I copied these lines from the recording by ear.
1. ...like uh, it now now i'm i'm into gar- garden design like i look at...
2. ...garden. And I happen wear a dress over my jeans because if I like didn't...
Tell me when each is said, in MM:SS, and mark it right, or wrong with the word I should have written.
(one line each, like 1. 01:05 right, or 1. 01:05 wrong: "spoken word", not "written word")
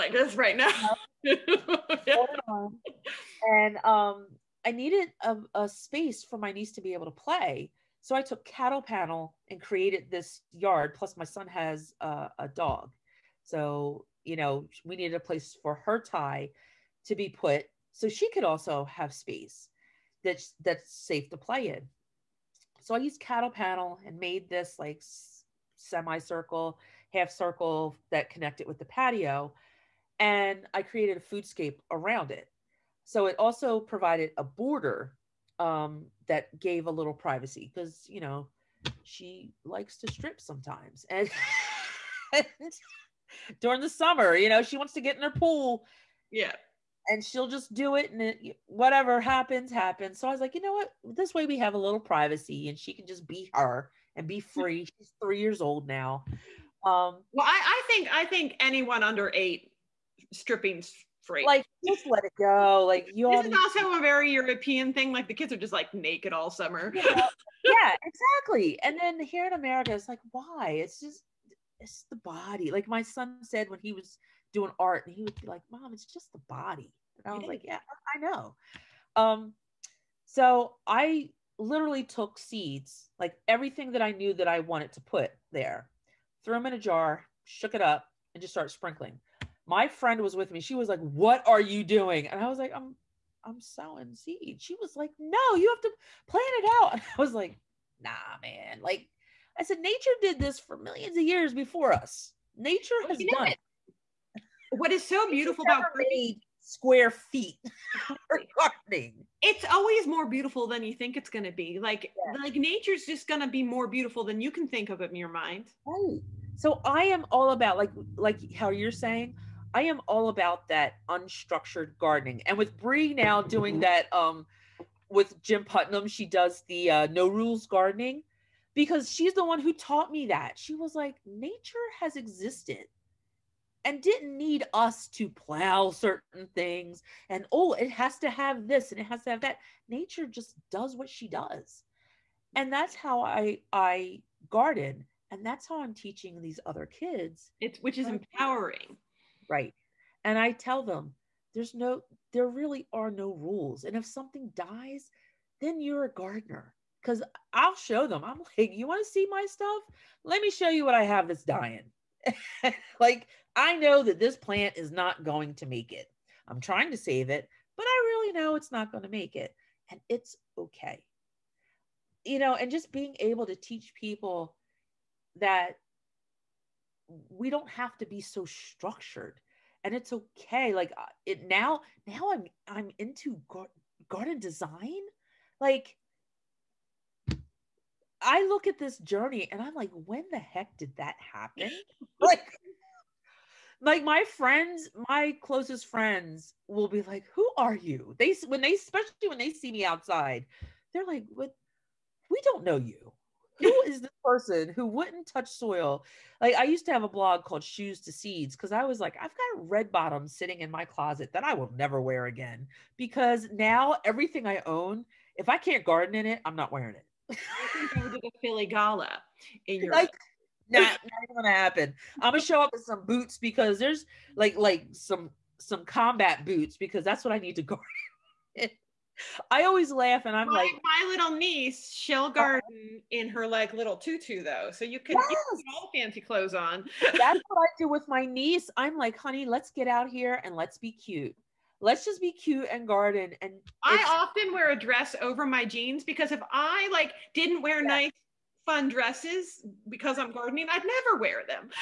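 1. 03:00 right
2. 04:02 wrong: "often", not "happen".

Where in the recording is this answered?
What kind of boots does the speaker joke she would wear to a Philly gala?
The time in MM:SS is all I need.
03:45.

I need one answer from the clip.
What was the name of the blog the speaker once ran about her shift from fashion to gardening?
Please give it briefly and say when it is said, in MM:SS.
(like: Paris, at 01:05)
Shoes to Seeds, at 03:27.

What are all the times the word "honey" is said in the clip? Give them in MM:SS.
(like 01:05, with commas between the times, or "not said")
03:59.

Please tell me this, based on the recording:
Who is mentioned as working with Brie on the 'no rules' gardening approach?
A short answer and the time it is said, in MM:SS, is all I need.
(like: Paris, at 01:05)
Jim Putnam, at 02:05.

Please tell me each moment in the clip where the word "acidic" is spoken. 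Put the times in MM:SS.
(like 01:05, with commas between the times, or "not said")
not said.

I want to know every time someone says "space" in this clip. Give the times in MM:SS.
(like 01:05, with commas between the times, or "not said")
00:05, 00:19.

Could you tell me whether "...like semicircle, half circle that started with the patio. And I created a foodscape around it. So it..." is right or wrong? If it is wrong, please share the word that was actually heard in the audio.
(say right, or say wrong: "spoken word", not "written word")
wrong: "connected", not "started".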